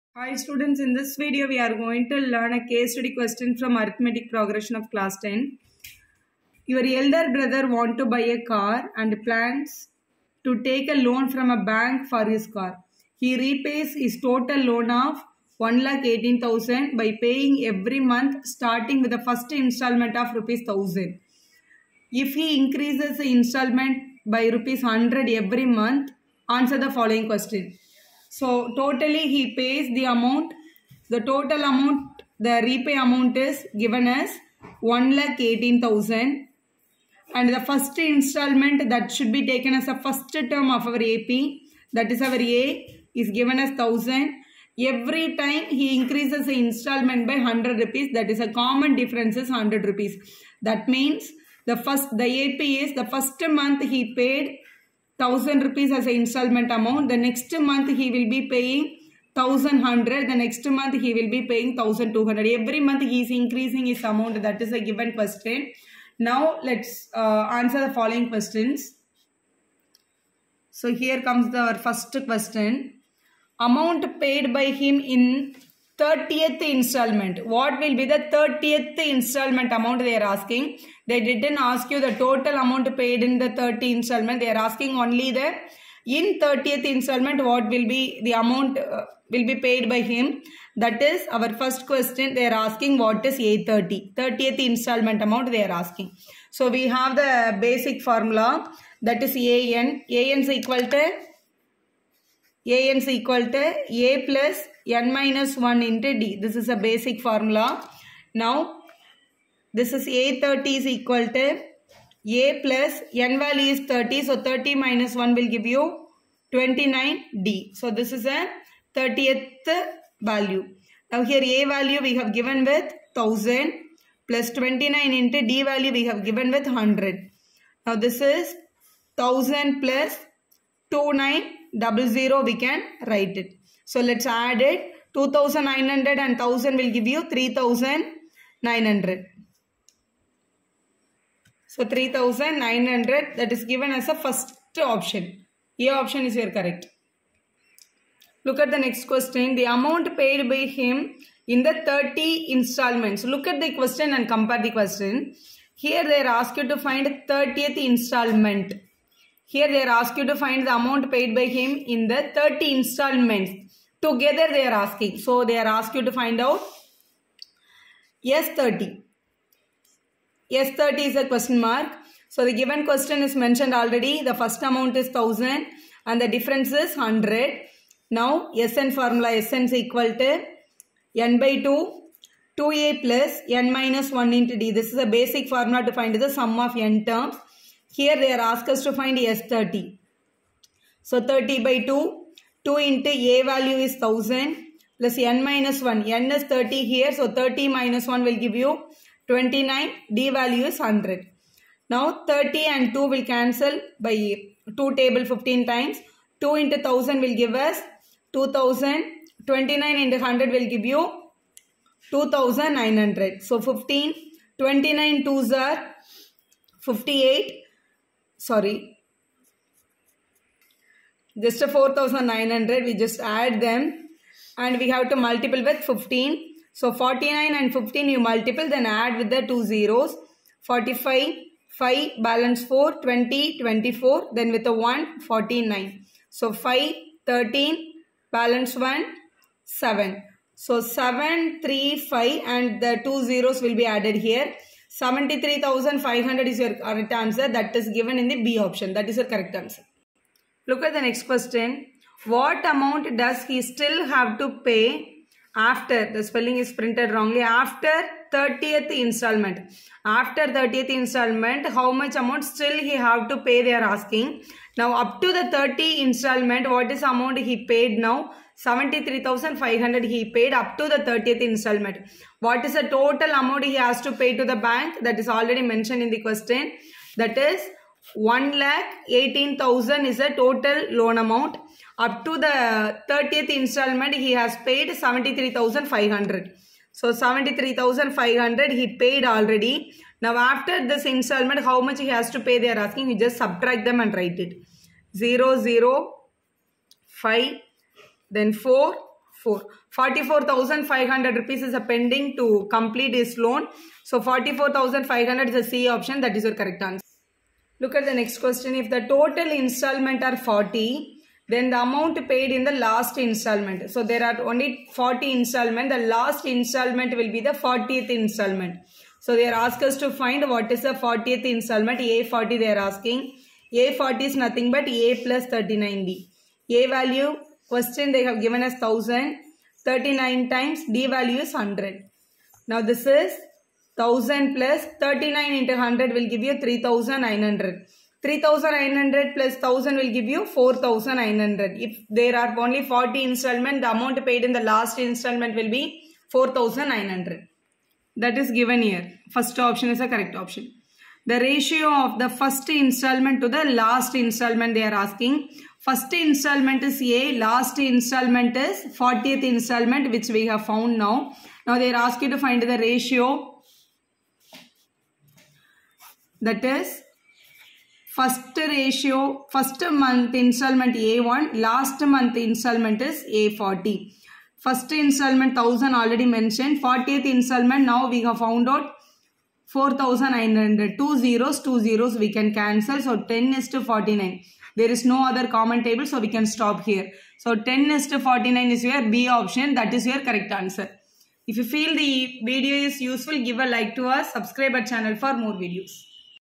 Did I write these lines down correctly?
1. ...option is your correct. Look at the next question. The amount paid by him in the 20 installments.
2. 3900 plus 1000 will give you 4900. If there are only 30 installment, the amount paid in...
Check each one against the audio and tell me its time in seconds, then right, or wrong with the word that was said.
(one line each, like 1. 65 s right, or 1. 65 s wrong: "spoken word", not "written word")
1. 145 s wrong: "30", not "20"
2. 338 s wrong: "40", not "30".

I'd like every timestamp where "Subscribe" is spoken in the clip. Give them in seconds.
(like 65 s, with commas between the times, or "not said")
394 s.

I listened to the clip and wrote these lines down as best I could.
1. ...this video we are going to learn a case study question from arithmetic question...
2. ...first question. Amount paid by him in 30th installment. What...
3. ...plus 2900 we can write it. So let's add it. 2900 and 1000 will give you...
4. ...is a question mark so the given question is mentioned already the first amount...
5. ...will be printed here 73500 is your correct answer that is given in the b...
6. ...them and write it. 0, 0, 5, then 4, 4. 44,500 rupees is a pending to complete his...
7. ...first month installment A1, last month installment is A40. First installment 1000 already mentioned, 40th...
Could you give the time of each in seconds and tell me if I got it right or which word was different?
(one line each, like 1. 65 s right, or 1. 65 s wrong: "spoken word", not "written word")
1. 0 s wrong: "progression", not "question"
2. 71 s right
3. 129 s right
4. 171 s right
5. 243 s wrong: "added", not "printed"
6. 293 s right
7. 369 s right.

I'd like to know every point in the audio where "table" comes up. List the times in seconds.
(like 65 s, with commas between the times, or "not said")
205 s, 385 s.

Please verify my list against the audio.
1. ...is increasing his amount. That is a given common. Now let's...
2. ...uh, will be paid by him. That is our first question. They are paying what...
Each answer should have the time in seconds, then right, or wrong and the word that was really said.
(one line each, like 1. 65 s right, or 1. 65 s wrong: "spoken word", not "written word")
1. 63 s wrong: "question", not "common"
2. 88 s wrong: "asking", not "paying".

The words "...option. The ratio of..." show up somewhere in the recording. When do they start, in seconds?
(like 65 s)
350 s.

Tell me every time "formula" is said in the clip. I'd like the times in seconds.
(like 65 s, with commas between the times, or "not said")
98 s, 107 s, 178 s, 185 s.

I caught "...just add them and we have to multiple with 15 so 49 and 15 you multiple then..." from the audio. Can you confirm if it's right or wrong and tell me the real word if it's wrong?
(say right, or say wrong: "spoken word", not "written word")
right.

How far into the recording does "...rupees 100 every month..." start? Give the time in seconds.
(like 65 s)
24 s.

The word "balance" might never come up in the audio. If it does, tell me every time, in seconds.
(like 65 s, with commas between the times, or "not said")
232 s, 238 s.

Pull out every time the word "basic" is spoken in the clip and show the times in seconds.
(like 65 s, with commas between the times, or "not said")
97 s, 106 s, 185 s.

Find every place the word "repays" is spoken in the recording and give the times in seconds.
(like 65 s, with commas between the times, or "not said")
13 s, 32 s.